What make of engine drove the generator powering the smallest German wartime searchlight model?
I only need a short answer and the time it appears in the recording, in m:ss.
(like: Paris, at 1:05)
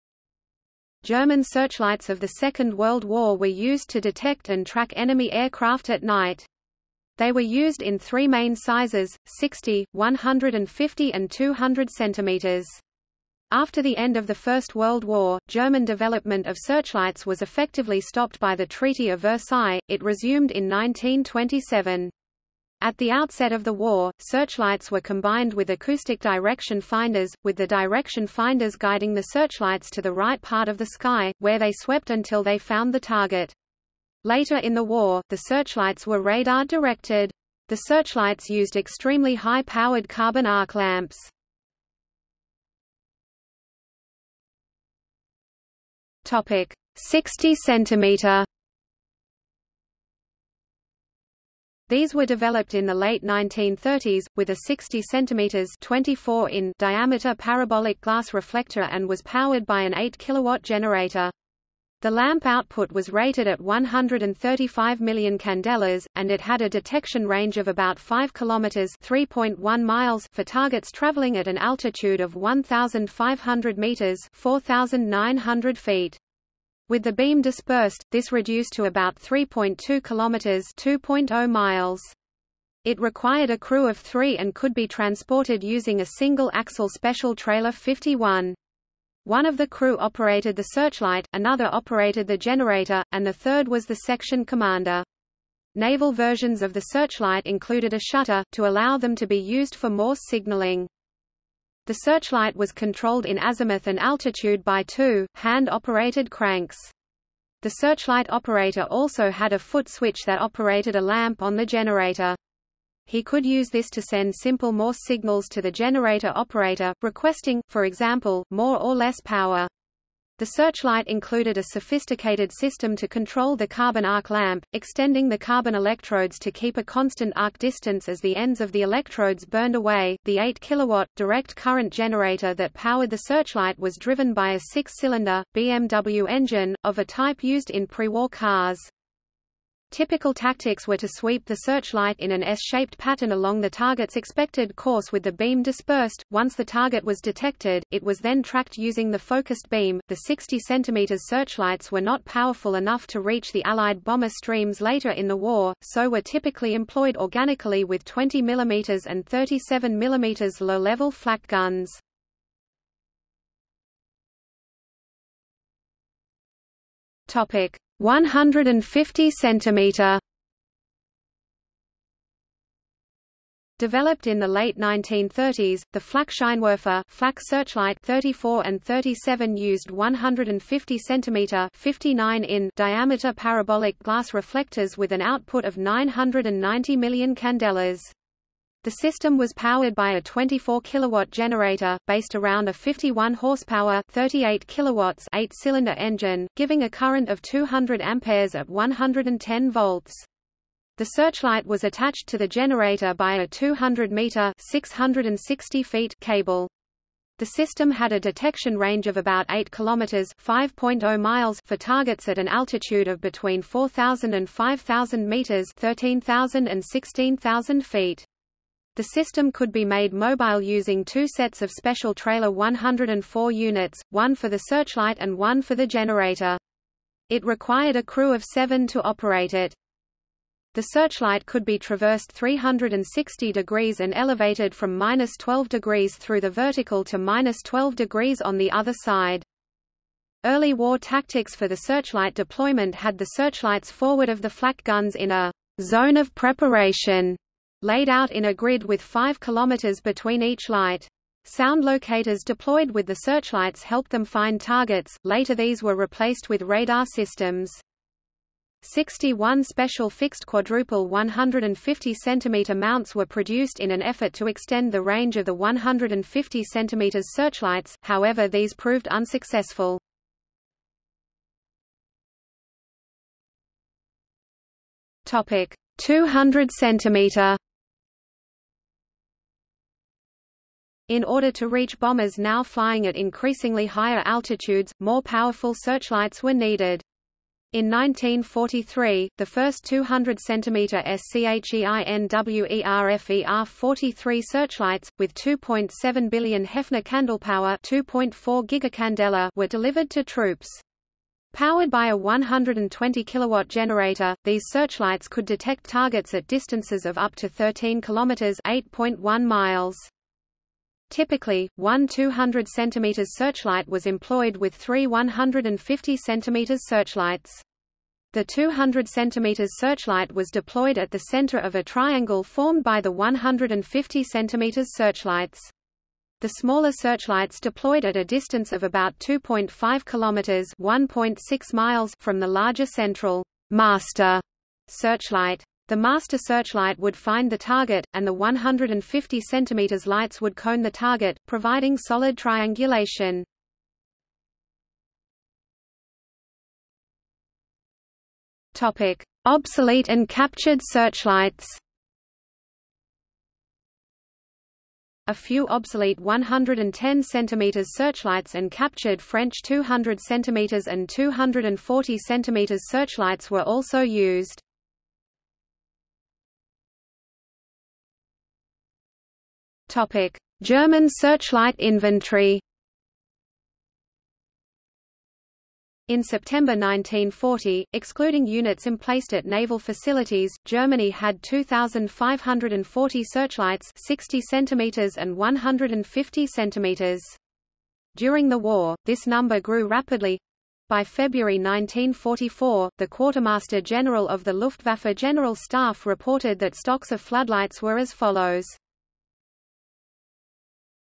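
BMW, at 2:15.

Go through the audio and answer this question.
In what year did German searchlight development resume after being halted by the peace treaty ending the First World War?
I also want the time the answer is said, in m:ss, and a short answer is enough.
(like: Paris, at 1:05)
1927, at 0:20.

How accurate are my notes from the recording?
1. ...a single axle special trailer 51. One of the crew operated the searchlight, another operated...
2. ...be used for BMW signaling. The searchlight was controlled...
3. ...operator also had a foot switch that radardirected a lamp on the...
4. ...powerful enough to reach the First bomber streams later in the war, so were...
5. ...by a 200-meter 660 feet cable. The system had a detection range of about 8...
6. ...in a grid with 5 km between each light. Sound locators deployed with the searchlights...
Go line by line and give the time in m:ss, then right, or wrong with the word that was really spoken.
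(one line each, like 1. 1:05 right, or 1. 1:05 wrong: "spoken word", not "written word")
1. 1:26 right
2. 1:39 wrong: "Morse", not "BMW"
3. 1:48 wrong: "operated", not "radardirected"
4. 2:32 wrong: "Allied", not "First"
5. 3:23 right
6. 4:08 right.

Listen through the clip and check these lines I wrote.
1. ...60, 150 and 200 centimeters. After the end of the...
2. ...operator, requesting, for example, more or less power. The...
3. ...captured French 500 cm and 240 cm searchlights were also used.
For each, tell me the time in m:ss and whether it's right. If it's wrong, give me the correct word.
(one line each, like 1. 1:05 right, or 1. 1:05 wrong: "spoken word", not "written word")
1. 0:09 right
2. 1:56 right
3. 5:58 wrong: "200", not "500".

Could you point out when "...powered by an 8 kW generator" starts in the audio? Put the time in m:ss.
0:59.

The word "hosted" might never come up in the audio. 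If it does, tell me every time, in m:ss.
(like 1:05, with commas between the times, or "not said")
not said.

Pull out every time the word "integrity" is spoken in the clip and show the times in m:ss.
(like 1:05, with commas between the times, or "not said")
not said.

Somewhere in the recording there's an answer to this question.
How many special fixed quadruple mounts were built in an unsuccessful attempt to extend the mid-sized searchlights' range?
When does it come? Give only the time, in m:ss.
4:18.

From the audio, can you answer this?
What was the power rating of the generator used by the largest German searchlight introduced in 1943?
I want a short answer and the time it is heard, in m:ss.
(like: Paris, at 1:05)
120 kilowatts, at 5:02.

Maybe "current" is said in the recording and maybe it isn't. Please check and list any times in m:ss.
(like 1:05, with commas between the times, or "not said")
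2:11, 3:16.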